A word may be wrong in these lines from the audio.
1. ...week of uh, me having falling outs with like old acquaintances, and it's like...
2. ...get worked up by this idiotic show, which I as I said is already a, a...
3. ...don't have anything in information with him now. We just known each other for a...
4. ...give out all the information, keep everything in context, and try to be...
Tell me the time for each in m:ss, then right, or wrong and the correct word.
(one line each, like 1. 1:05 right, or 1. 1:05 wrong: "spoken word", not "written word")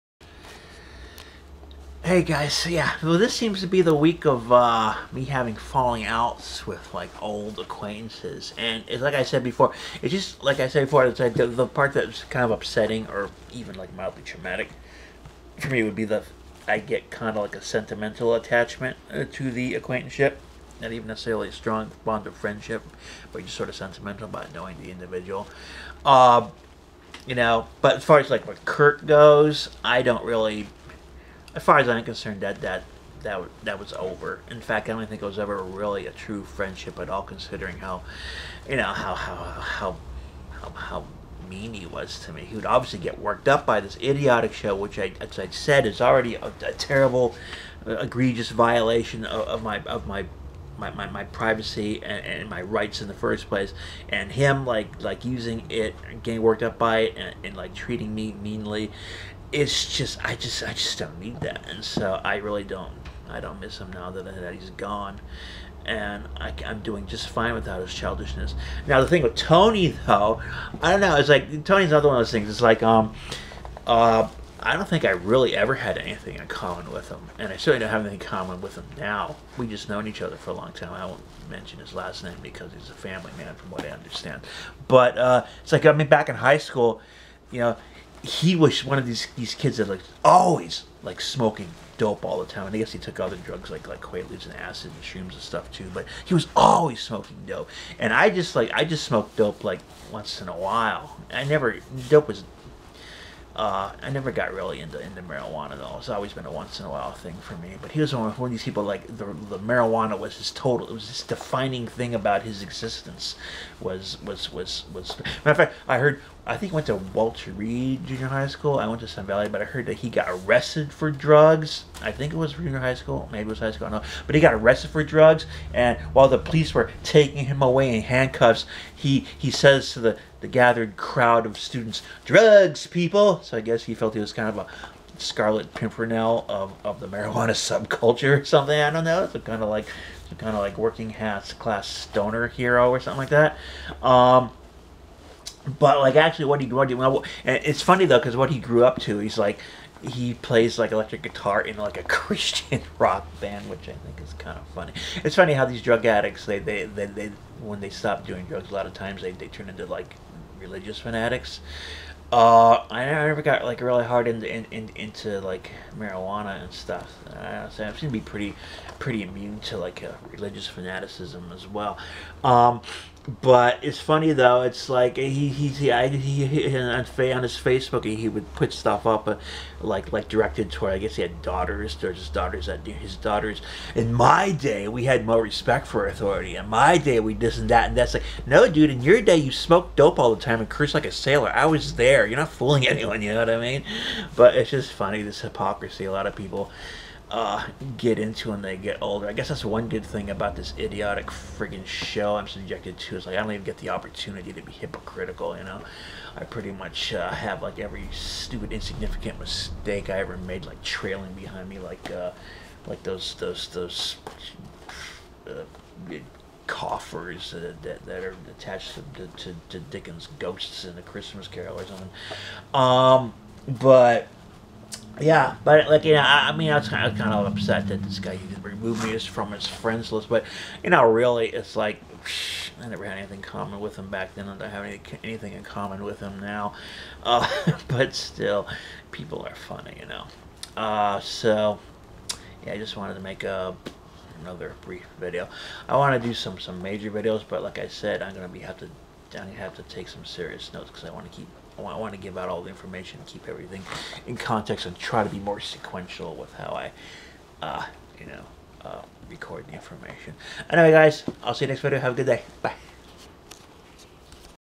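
1. 0:03 right
2. 0:42 right
3. 1:17 wrong: "common", not "information"
4. 4:12 right.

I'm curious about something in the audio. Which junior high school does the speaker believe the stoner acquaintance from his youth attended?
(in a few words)
Walter Reed Junior High School.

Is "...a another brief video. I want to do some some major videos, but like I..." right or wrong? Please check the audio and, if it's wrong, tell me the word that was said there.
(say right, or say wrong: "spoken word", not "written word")
right.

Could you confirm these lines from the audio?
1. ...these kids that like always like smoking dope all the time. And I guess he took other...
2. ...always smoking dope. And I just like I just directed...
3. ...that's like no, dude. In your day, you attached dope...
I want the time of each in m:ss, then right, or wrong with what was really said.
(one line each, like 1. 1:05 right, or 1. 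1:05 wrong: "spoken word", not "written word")
1. 1:29 right
2. 1:36 wrong: "smoked", not "directed"
3. 3:07 wrong: "smoked", not "attached".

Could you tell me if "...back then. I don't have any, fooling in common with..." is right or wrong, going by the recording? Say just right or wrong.
wrong.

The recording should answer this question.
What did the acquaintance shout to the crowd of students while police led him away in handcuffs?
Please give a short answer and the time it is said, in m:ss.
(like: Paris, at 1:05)
Drugs, people!, at 2:12.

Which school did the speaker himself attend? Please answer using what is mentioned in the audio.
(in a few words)
Sun Valley.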